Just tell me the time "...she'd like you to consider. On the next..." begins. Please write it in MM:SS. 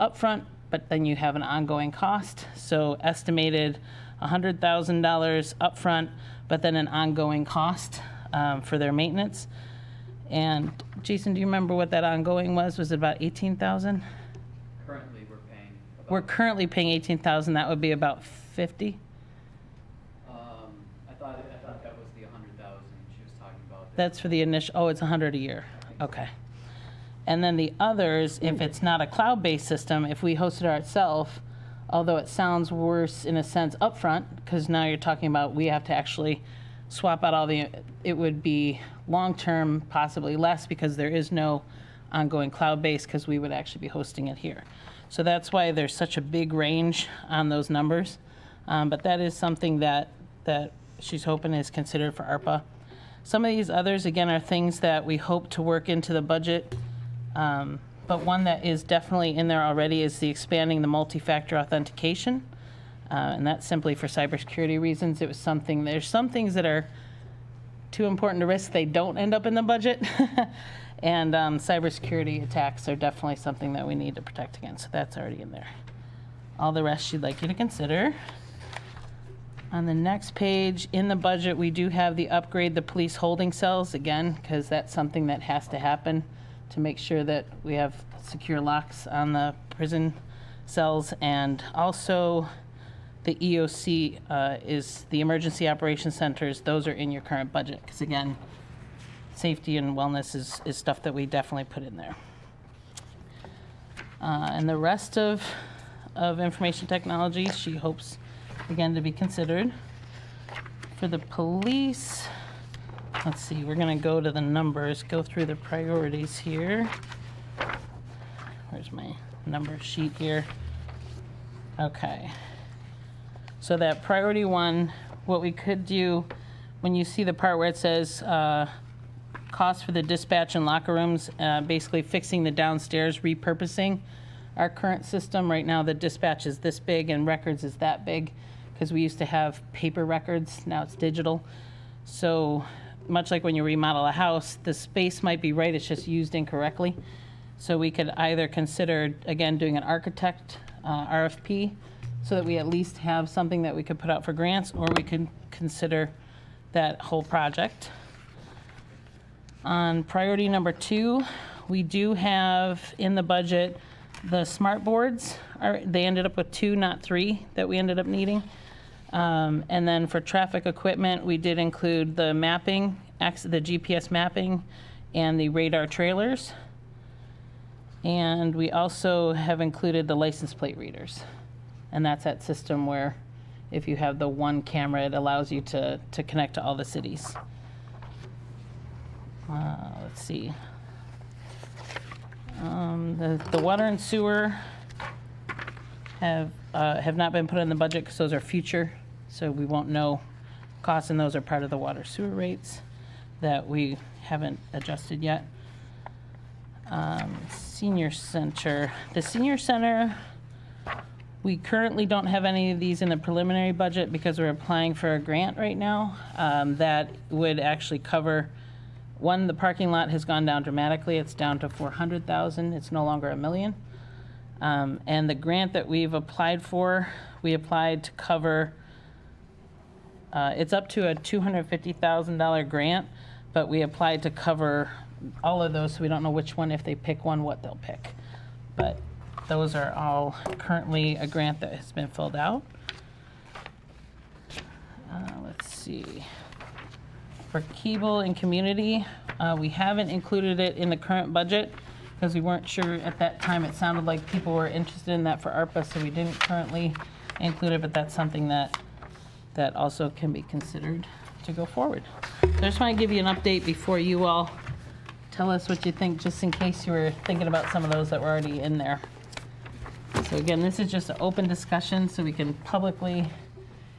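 01:17.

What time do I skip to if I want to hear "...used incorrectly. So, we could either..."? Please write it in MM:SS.
02:26.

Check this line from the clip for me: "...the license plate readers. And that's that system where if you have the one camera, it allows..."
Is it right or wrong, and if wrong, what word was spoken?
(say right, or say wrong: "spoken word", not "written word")
right.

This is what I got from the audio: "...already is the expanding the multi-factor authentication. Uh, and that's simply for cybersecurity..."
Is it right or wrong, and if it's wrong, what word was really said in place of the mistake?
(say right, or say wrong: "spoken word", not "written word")
right.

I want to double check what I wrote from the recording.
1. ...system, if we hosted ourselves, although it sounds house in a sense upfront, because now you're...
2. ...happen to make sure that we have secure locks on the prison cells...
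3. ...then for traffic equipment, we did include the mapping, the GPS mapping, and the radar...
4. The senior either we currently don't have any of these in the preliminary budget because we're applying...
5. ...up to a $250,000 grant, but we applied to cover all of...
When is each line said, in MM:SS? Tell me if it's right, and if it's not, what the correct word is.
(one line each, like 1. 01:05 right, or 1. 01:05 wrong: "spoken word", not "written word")
1. 00:29 wrong: "worse", not "house"
2. 01:25 right
3. 02:49 right
4. 03:29 wrong: "center", not "either"
5. 03:50 right.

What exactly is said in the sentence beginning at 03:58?
But those are all currently a grant that has been filled out.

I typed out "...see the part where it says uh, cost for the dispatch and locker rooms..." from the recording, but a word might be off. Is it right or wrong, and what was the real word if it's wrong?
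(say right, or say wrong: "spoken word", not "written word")
right.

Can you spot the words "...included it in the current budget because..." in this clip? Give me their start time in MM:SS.
04:10.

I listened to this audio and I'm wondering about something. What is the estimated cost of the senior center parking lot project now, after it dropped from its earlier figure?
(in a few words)
400,000.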